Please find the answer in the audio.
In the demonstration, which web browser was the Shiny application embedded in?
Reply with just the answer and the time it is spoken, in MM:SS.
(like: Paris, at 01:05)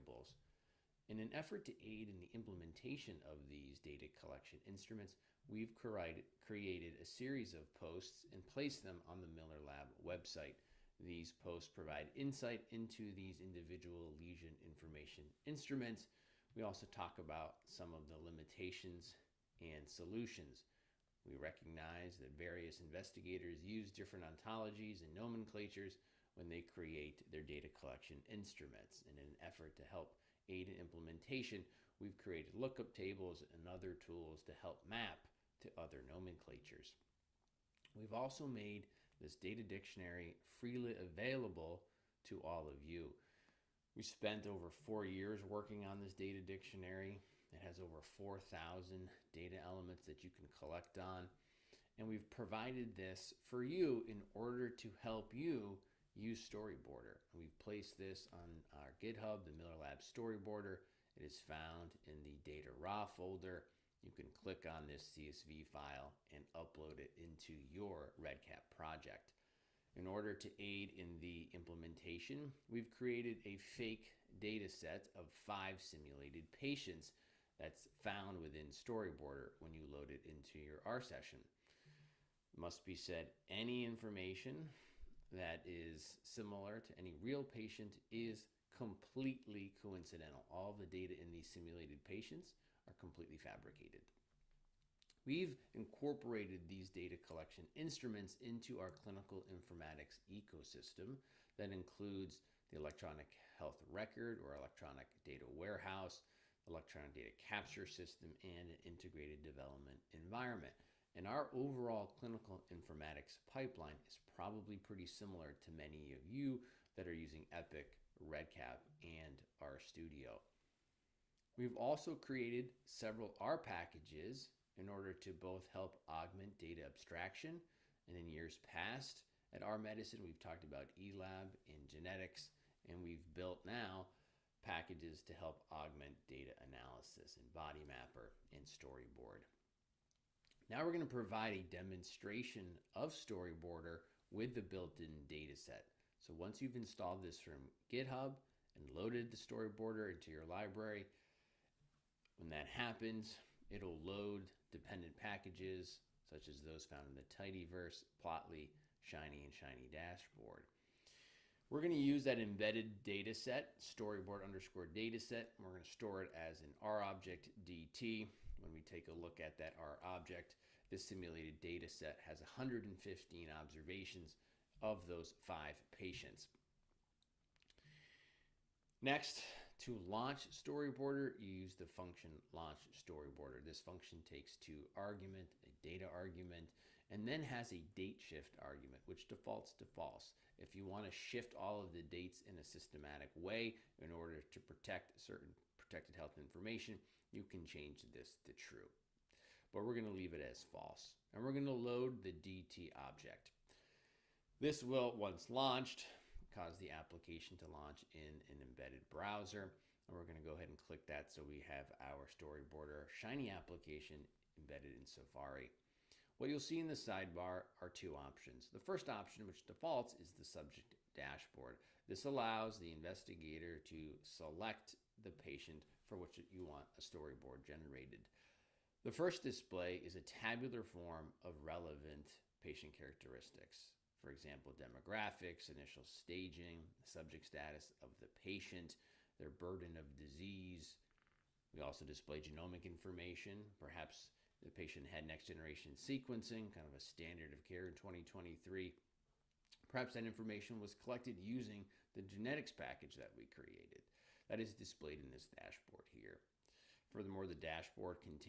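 Safari, at 03:35.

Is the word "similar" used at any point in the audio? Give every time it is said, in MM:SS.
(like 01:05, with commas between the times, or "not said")
01:26, 01:55.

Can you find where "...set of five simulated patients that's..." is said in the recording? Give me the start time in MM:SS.
01:14.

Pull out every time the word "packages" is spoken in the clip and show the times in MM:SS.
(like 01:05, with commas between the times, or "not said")
02:03, 02:14, 02:35, 04:12.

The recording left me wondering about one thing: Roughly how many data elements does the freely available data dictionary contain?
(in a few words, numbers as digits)
4,000.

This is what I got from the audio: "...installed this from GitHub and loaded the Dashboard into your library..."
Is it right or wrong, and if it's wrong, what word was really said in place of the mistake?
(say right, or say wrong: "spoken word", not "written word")
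wrong: "StoryboardR", not "Dashboard".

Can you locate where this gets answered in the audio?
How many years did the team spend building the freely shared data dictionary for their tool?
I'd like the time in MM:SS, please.
00:44.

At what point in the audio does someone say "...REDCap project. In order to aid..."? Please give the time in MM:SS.
01:08.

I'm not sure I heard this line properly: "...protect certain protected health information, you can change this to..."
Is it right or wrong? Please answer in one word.
right.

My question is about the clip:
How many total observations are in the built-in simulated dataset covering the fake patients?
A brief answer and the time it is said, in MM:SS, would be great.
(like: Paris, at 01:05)
115, at 02:52.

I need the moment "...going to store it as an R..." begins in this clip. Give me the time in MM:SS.
02:45.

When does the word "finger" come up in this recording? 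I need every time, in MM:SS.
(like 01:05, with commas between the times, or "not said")
not said.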